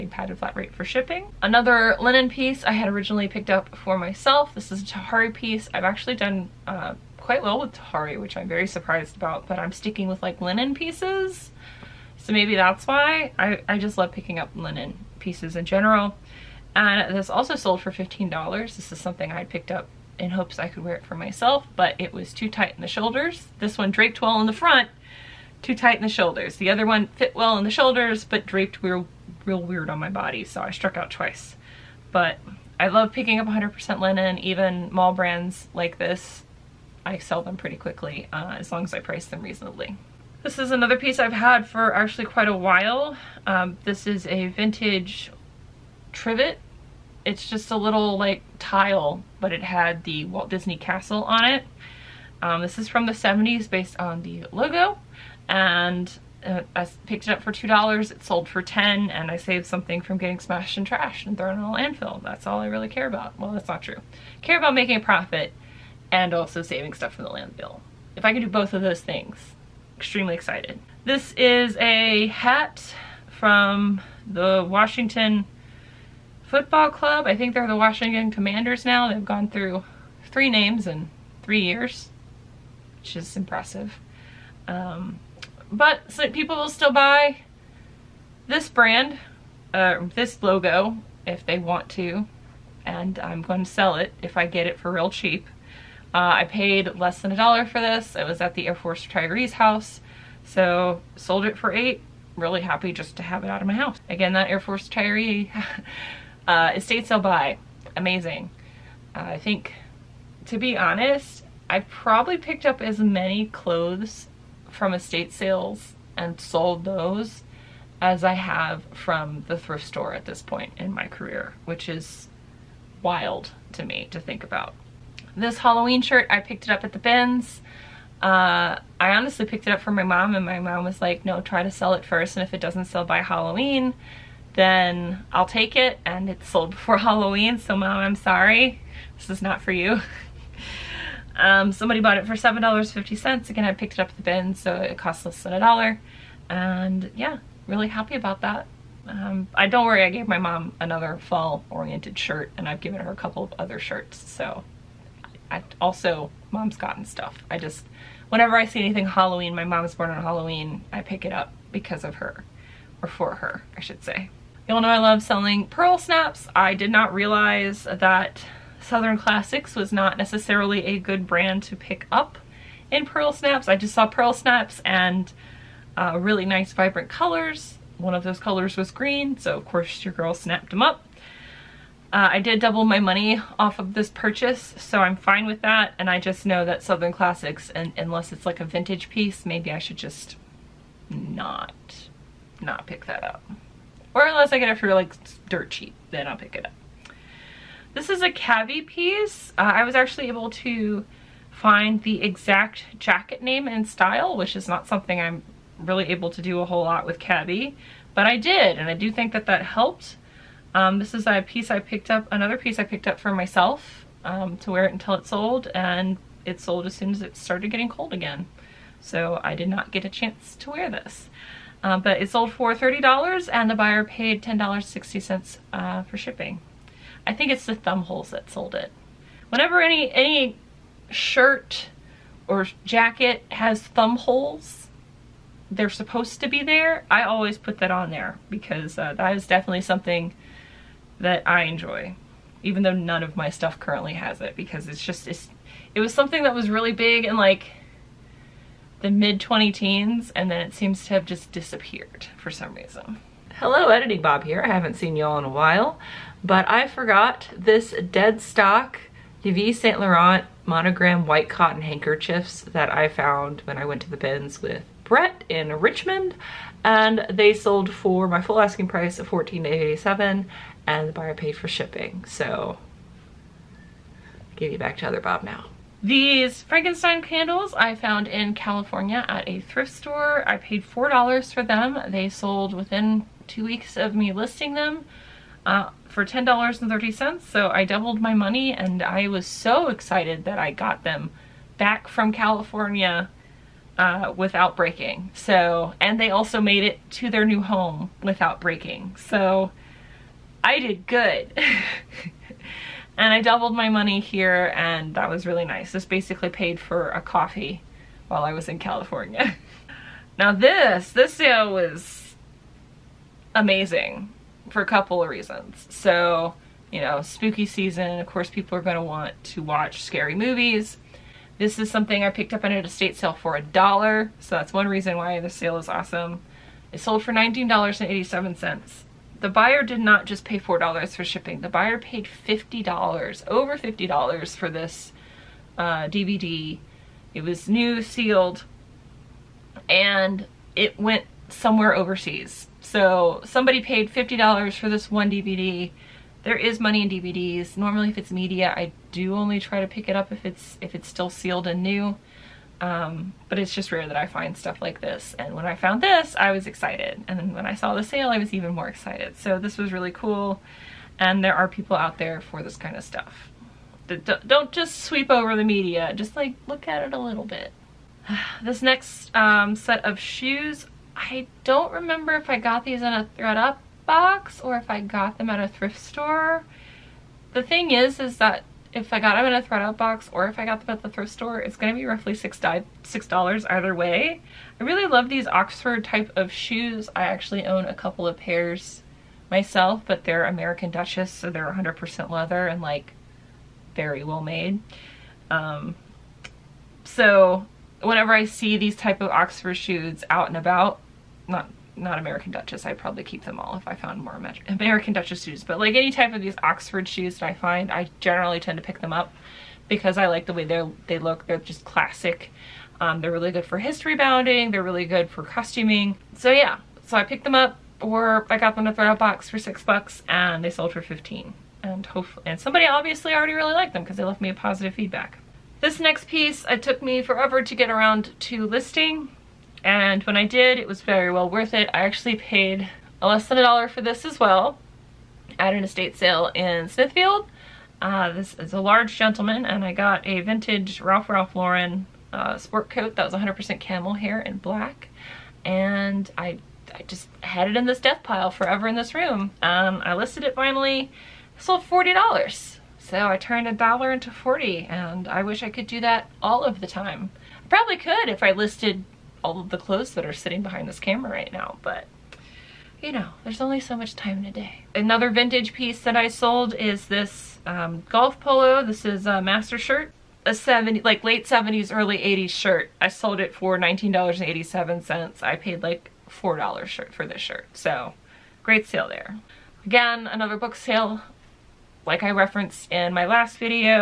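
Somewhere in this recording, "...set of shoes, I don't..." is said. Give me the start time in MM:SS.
06:09.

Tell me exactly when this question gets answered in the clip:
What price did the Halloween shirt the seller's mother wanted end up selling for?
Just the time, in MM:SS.
02:22.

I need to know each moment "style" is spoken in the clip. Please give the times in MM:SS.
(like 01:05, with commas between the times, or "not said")
03:23.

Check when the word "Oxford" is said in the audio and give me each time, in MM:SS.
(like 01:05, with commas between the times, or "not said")
06:25, 06:39, 06:46.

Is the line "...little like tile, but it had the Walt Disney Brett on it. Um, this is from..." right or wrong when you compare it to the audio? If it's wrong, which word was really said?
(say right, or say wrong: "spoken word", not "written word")
wrong: "Castle", not "Brett".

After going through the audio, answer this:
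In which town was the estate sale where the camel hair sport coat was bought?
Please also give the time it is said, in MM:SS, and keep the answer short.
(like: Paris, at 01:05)
Smithfield, at 07:16.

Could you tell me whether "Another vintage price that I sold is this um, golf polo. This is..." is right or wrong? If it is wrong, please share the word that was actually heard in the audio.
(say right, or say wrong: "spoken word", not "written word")
wrong: "piece", not "price".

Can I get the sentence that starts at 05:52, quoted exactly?
Um, but it's just rare that I find stuff like this.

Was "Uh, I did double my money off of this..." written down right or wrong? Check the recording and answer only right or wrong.
right.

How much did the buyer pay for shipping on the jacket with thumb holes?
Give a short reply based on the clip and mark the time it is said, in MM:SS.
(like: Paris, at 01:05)
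$10.60, at 03:44.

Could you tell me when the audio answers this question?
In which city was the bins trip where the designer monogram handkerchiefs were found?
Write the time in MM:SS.
04:25.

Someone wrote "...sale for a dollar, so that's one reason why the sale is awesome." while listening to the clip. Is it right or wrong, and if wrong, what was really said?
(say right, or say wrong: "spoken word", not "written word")
right.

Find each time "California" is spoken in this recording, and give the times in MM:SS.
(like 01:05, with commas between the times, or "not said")
04:38, 04:52, 05:08.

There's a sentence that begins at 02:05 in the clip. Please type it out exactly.
This Halloween shirt, I picked it up at the bins.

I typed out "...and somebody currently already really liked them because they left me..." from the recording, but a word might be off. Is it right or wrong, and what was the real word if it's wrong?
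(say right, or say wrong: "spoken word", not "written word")
wrong: "obviously", not "currently".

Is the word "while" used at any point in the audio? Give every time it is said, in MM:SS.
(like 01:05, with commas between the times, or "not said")
00:42, 04:15, 05:08.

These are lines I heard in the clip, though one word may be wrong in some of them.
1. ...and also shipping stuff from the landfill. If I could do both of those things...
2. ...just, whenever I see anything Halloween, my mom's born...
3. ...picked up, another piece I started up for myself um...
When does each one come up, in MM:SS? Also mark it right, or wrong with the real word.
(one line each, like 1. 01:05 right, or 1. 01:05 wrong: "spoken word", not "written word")
1. 01:06 wrong: "saving", not "shipping"
2. 02:37 right
3. 03:31 wrong: "picked", not "started".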